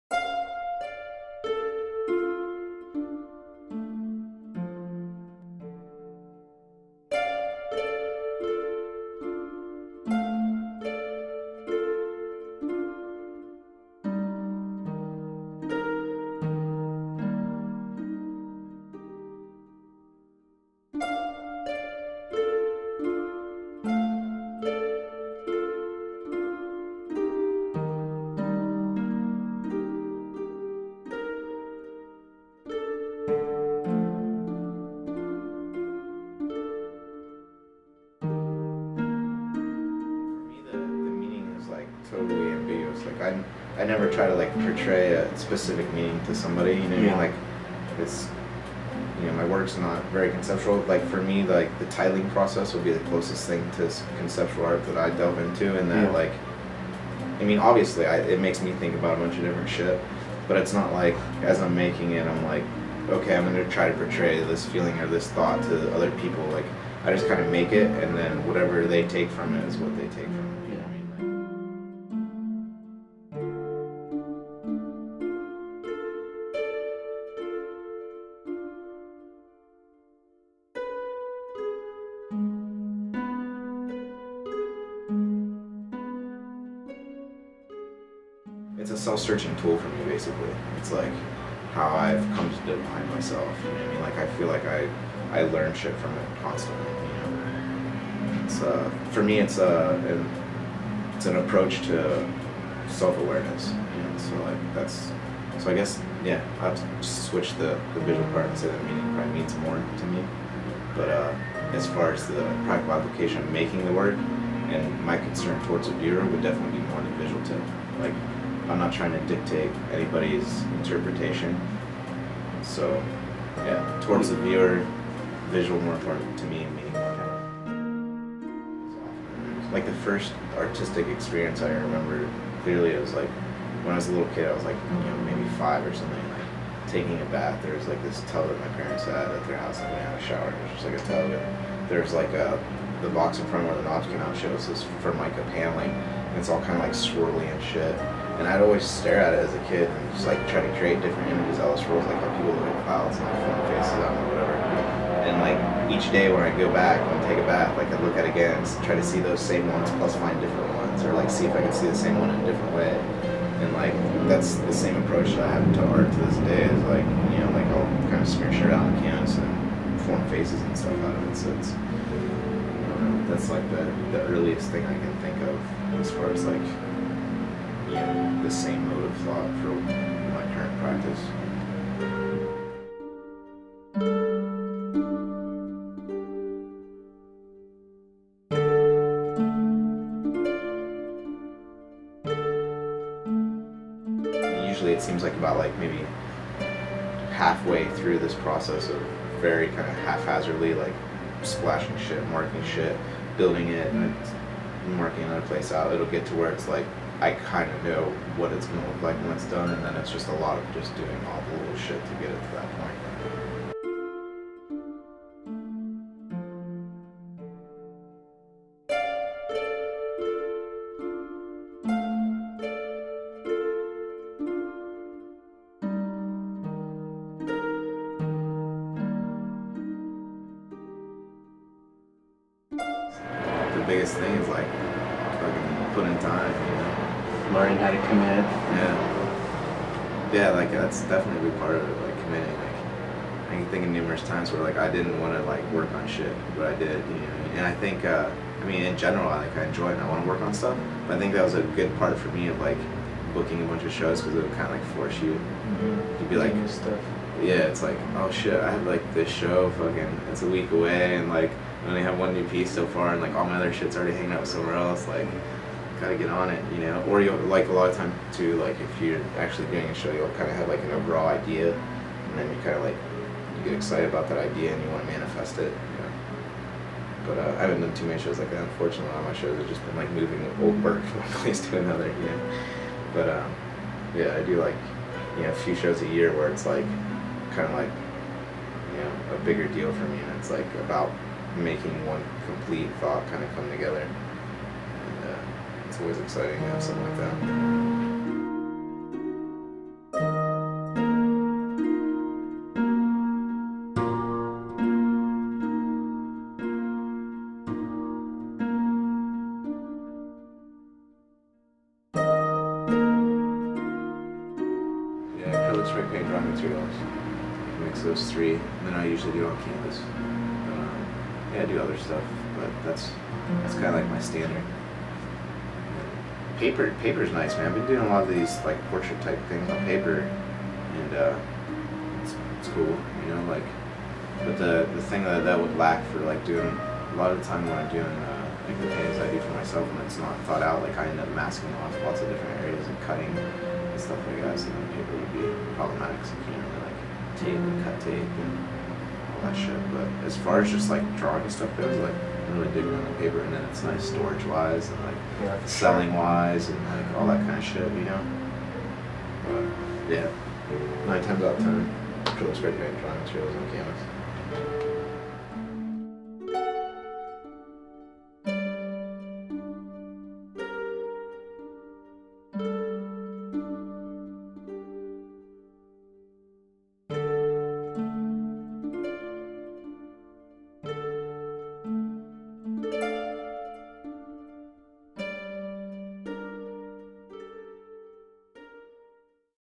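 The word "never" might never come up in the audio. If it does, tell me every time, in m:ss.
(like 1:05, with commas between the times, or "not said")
0:43.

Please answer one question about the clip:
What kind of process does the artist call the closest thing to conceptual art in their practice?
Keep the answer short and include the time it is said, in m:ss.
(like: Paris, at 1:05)
tiling process, at 0:51.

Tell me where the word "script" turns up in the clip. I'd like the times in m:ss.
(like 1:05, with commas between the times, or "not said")
not said.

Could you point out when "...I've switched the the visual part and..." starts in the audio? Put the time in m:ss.
1:46.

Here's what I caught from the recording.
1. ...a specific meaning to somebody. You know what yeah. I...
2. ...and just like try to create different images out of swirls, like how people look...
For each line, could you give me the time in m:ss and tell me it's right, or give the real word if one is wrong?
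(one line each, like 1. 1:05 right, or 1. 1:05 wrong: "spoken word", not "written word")
1. 0:45 right
2. 2:29 right.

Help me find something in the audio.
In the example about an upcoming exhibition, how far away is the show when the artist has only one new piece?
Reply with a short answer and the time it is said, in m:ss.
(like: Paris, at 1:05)
a week, at 4:20.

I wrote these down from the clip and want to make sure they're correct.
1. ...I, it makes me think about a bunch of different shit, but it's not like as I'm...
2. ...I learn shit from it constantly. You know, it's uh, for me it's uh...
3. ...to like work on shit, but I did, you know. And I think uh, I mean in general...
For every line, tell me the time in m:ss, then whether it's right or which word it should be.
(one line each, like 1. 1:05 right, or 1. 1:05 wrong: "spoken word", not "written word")
1. 0:58 right
2. 1:35 right
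3. 4:05 right.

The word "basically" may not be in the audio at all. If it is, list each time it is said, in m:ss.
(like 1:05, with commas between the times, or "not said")
1:30.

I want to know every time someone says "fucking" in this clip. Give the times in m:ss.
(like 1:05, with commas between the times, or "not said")
3:55, 4:19.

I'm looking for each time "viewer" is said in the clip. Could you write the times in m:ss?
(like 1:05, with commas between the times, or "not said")
1:55, 2:04.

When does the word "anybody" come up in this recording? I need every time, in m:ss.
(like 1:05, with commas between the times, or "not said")
1:59.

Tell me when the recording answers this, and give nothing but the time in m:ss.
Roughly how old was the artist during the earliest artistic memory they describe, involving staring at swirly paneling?
2:15.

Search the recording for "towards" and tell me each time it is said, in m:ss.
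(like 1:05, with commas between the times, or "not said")
1:55, 2:04.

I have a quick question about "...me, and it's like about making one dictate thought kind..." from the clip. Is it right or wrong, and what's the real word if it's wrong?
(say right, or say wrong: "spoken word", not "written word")
wrong: "complete", not "dictate".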